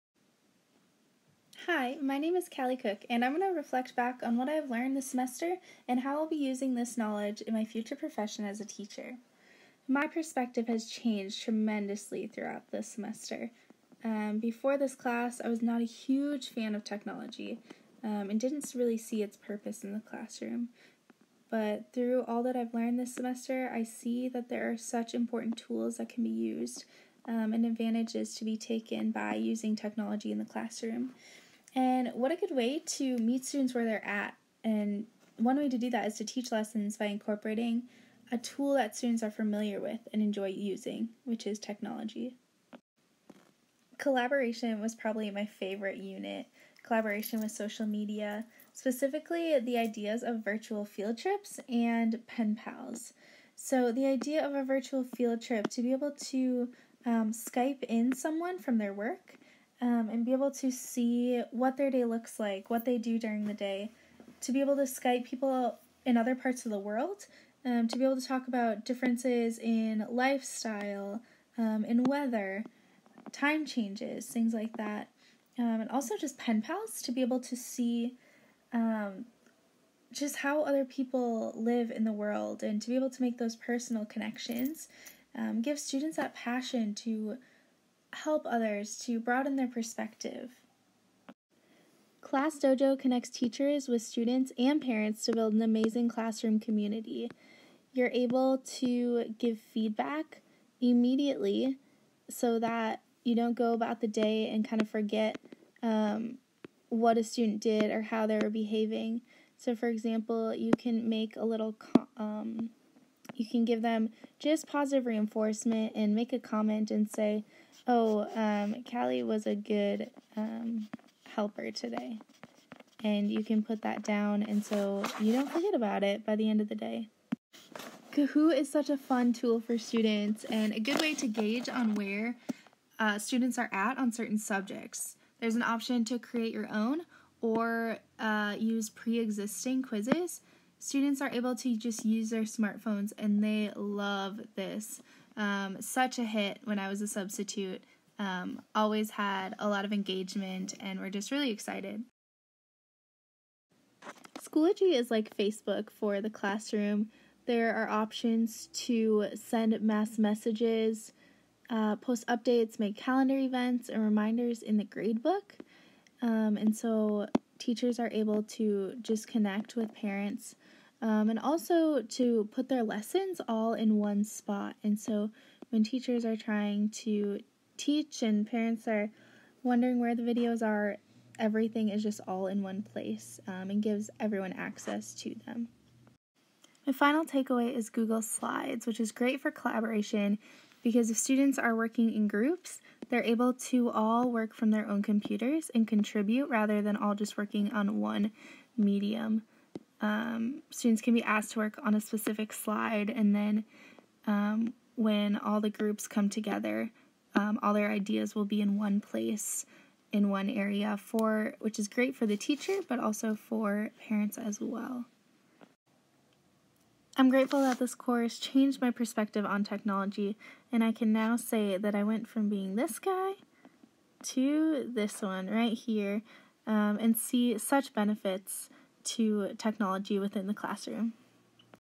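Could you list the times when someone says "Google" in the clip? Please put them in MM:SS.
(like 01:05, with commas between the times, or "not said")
03:07.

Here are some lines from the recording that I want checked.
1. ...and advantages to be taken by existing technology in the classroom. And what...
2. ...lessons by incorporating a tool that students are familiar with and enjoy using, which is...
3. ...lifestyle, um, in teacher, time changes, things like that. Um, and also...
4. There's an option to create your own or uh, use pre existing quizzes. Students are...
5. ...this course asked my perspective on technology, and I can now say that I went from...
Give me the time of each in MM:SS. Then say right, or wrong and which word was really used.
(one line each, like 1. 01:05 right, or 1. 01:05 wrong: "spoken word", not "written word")
1. 00:27 wrong: "using", not "existing"
2. 00:36 right
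3. 01:10 wrong: "weather", not "teacher"
4. 02:15 right
5. 03:37 wrong: "changed", not "asked".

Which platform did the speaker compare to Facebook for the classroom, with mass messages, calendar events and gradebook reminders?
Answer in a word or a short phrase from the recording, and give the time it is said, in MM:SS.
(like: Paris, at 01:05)
Schoology, at 02:34.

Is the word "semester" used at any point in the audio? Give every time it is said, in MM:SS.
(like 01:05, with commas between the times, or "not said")
00:05, 00:12, 00:23.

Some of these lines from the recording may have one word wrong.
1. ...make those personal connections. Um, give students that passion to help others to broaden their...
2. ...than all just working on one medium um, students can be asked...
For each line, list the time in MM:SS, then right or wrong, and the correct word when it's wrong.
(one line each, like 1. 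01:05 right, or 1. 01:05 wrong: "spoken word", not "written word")
1. 01:23 right
2. 03:16 right.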